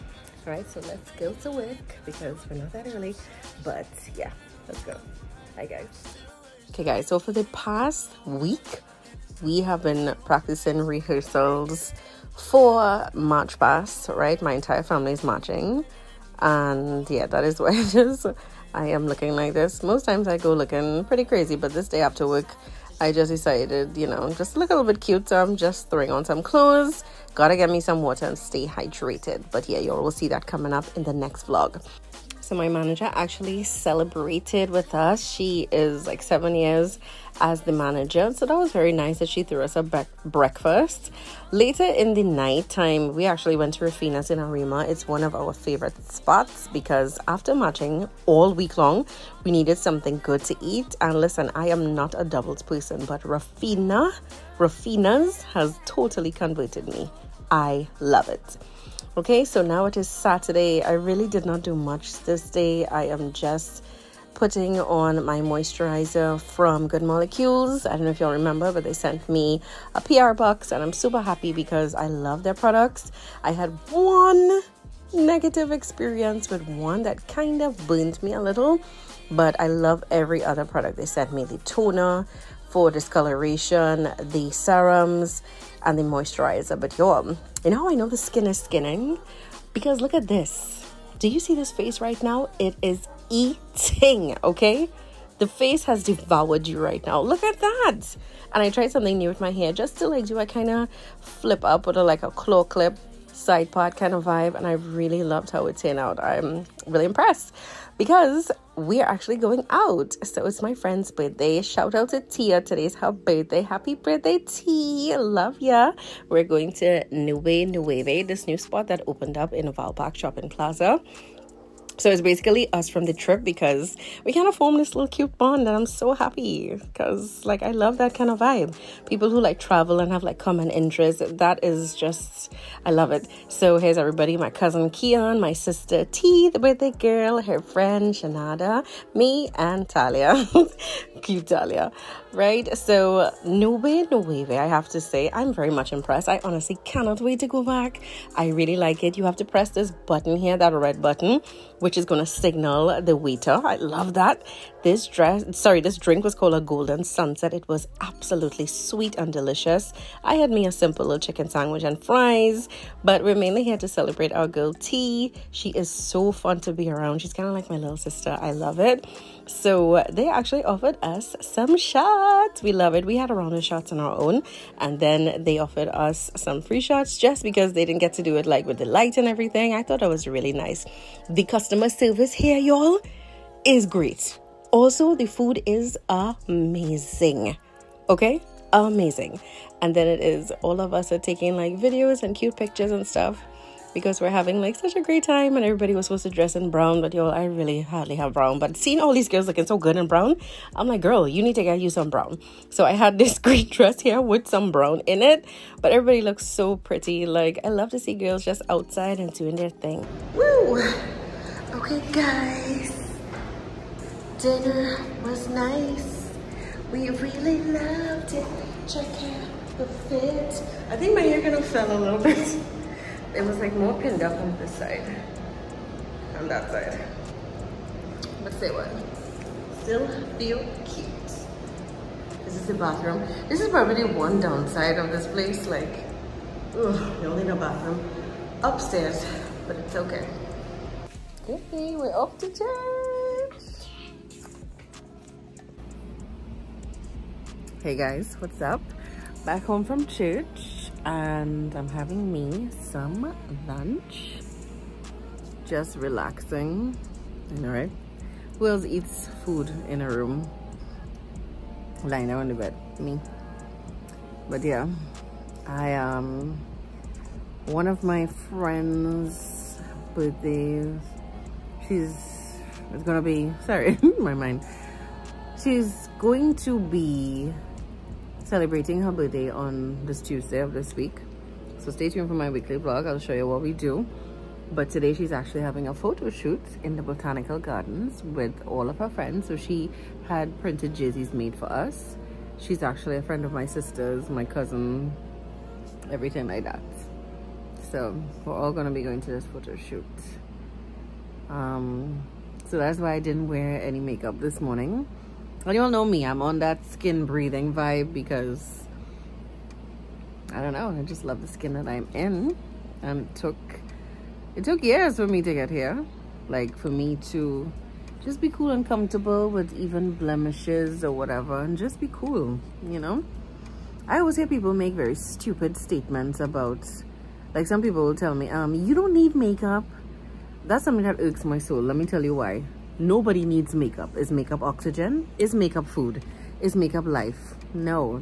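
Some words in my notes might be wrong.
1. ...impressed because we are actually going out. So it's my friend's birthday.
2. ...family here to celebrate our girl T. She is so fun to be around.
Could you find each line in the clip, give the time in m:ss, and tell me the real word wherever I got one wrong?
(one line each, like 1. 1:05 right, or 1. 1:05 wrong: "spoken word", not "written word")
1. 1:47 right
2. 2:43 wrong: "mainly", not "family".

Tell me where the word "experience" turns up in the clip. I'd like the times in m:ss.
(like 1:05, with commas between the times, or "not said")
1:15.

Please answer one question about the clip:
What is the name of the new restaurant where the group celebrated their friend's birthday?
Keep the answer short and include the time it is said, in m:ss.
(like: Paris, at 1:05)
Nube Nueve, at 1:57.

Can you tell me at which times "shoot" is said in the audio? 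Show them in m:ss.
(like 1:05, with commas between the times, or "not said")
4:46, 4:59.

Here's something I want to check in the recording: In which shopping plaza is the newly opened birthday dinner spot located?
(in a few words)
Valpark Shopping Plaza.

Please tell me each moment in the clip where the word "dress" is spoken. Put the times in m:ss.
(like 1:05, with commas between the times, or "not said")
2:35, 3:16, 3:23.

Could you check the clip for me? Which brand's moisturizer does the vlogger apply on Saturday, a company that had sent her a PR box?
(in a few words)
Good Molecules.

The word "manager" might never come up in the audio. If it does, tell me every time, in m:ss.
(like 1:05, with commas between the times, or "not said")
0:32, 0:37.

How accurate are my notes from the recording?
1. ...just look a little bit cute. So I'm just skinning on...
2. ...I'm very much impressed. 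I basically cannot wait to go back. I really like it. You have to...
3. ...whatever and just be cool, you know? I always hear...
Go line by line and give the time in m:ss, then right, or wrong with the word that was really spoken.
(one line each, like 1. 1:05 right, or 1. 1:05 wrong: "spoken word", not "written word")
1. 0:24 wrong: "throwing", not "skinning"
2. 2:25 wrong: "honestly", not "basically"
3. 5:21 right.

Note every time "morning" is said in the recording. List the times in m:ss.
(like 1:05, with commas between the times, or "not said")
5:04.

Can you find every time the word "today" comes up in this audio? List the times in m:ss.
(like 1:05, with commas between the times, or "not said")
1:52, 4:44.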